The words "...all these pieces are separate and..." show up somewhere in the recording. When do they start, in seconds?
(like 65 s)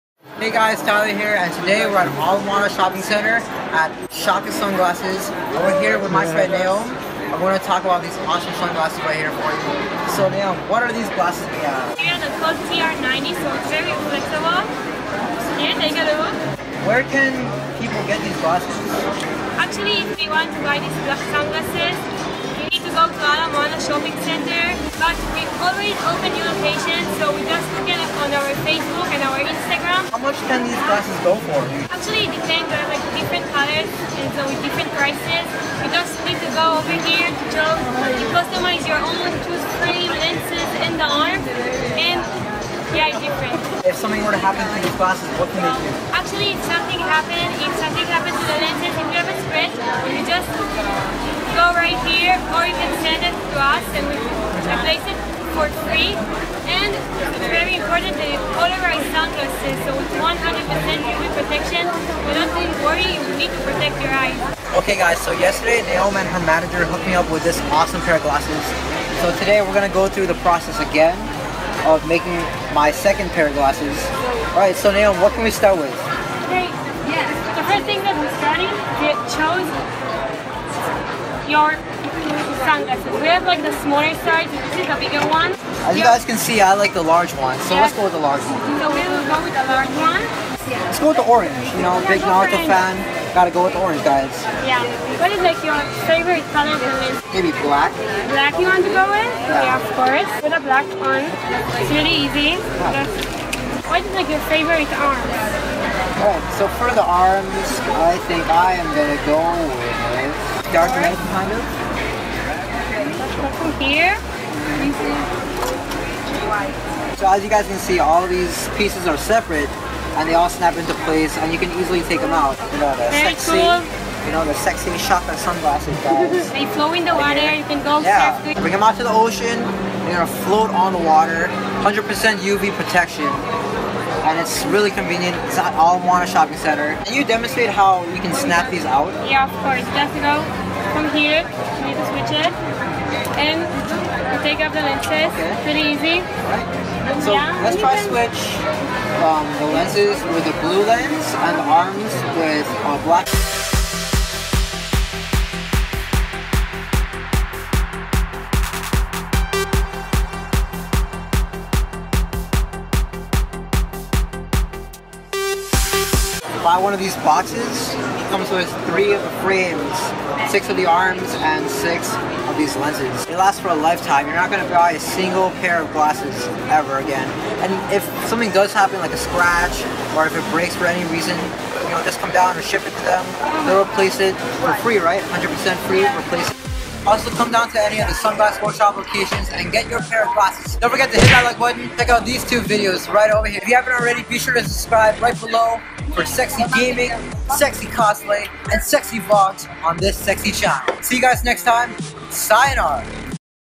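117 s.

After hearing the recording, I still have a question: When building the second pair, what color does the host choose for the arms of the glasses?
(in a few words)
dark.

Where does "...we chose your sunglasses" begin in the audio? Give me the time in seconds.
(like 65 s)
79 s.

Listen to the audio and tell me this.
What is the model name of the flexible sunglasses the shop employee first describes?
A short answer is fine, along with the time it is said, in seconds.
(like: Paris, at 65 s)
Code TR90, at 12 s.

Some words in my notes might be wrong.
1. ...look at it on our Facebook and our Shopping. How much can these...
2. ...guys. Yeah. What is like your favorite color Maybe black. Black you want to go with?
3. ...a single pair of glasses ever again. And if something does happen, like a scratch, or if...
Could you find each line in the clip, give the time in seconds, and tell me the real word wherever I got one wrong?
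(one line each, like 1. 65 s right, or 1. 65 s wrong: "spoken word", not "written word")
1. 27 s wrong: "Instagram", not "Shopping"
2. 94 s right
3. 174 s right.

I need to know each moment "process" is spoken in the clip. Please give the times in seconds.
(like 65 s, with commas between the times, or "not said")
70 s.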